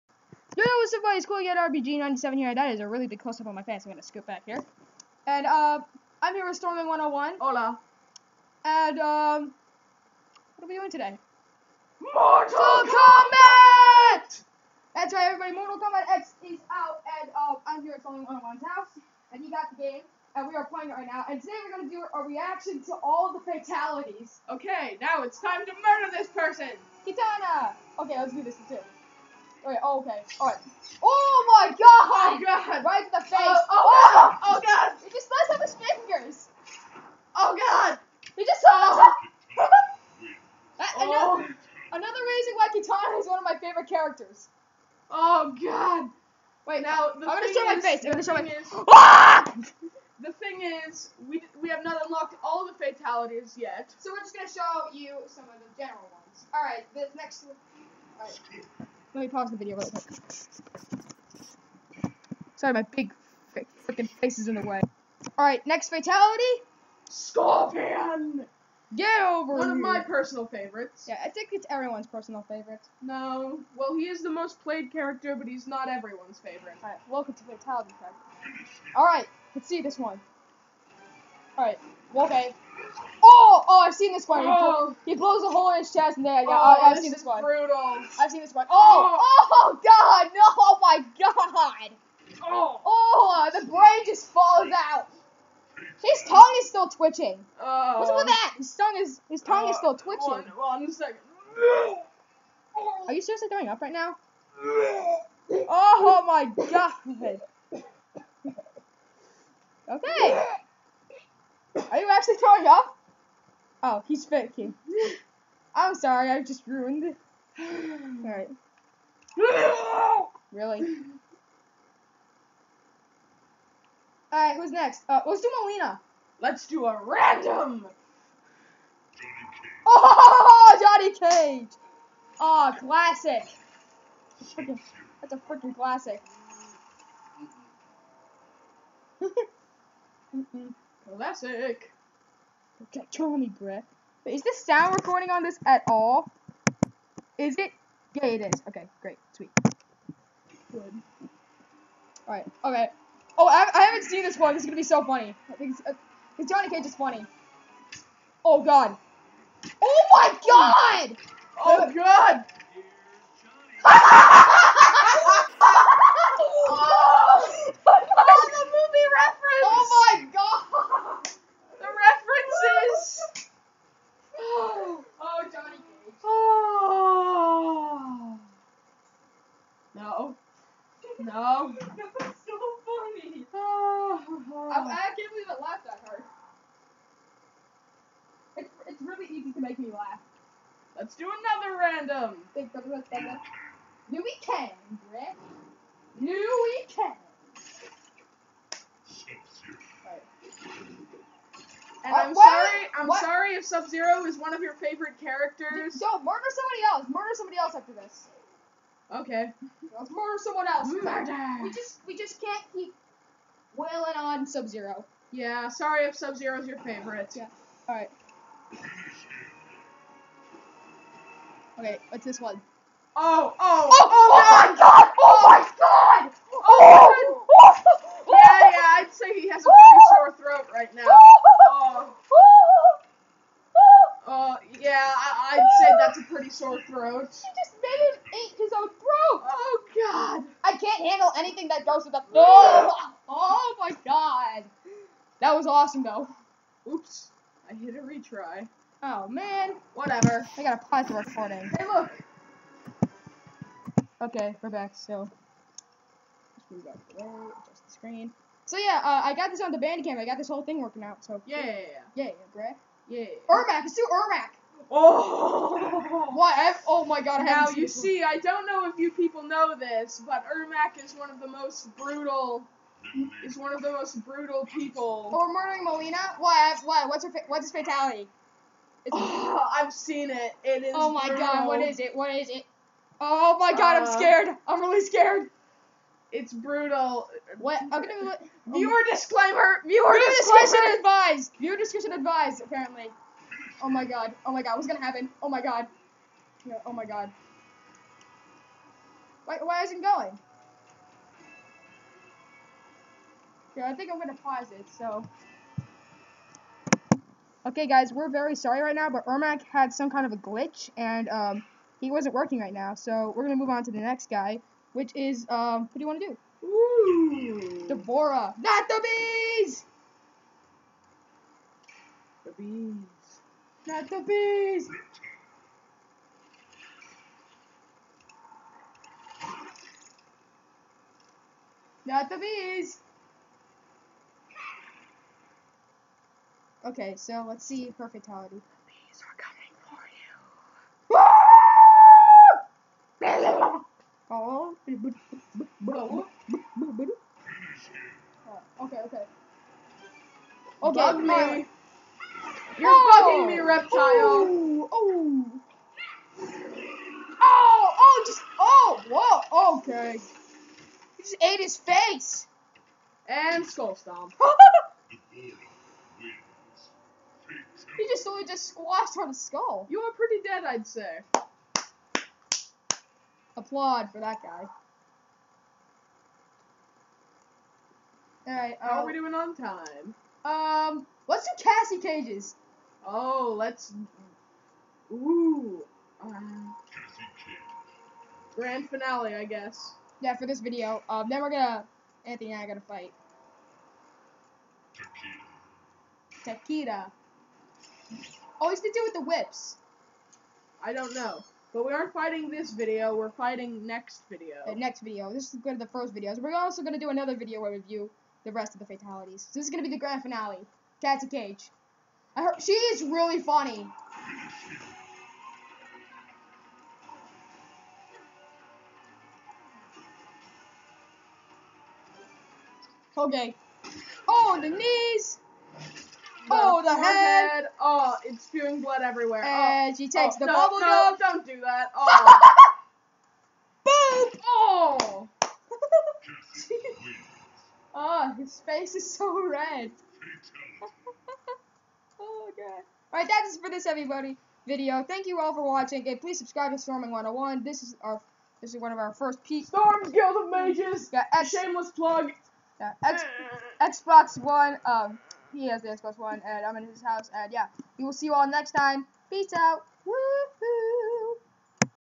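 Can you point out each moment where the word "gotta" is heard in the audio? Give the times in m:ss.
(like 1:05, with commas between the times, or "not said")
4:10.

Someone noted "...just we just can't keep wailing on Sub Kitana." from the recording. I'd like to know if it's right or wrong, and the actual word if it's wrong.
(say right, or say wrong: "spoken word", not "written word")
wrong: "Zero", not "Kitana".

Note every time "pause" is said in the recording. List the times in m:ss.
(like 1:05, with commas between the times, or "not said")
0:59, 4:10, 5:04.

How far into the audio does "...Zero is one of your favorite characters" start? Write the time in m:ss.
3:23.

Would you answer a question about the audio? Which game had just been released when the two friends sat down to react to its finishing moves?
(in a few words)
Mortal Kombat X.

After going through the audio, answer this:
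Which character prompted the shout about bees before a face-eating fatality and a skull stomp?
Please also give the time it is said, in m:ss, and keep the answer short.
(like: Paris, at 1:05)
D'Vorah, at 5:17.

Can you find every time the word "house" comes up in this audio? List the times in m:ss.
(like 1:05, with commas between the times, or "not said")
0:18, 7:37.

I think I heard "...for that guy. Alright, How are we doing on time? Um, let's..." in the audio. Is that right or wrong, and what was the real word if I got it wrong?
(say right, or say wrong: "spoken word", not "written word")
right.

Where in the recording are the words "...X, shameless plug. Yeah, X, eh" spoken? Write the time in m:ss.
7:31.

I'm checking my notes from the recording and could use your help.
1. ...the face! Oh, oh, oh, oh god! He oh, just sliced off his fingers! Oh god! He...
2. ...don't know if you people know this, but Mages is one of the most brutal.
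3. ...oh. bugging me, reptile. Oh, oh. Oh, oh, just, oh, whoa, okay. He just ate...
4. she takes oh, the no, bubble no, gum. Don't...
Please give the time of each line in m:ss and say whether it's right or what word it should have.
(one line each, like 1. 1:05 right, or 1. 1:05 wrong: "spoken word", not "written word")
1. 0:33 right
2. 4:28 wrong: "Ermac", not "Mages"
3. 5:52 right
4. 7:09 right.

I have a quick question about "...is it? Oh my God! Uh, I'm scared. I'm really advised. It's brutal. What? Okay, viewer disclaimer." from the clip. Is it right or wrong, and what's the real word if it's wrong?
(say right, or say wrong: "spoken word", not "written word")
wrong: "scared", not "advised".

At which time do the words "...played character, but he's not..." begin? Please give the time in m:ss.
1:14.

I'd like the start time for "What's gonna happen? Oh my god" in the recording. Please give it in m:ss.
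4:54.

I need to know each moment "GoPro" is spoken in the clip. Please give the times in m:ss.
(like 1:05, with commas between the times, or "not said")
not said.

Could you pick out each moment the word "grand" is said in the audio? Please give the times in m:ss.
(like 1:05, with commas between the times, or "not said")
6:28, 6:49.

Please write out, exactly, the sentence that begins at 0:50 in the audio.
the thing is, we we have not unlocked all the fatalities yet.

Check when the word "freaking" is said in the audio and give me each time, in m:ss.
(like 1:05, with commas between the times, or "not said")
1:03, 2:15.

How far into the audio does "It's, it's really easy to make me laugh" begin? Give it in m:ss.
3:08.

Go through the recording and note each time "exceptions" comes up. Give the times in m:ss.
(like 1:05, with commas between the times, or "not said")
not said.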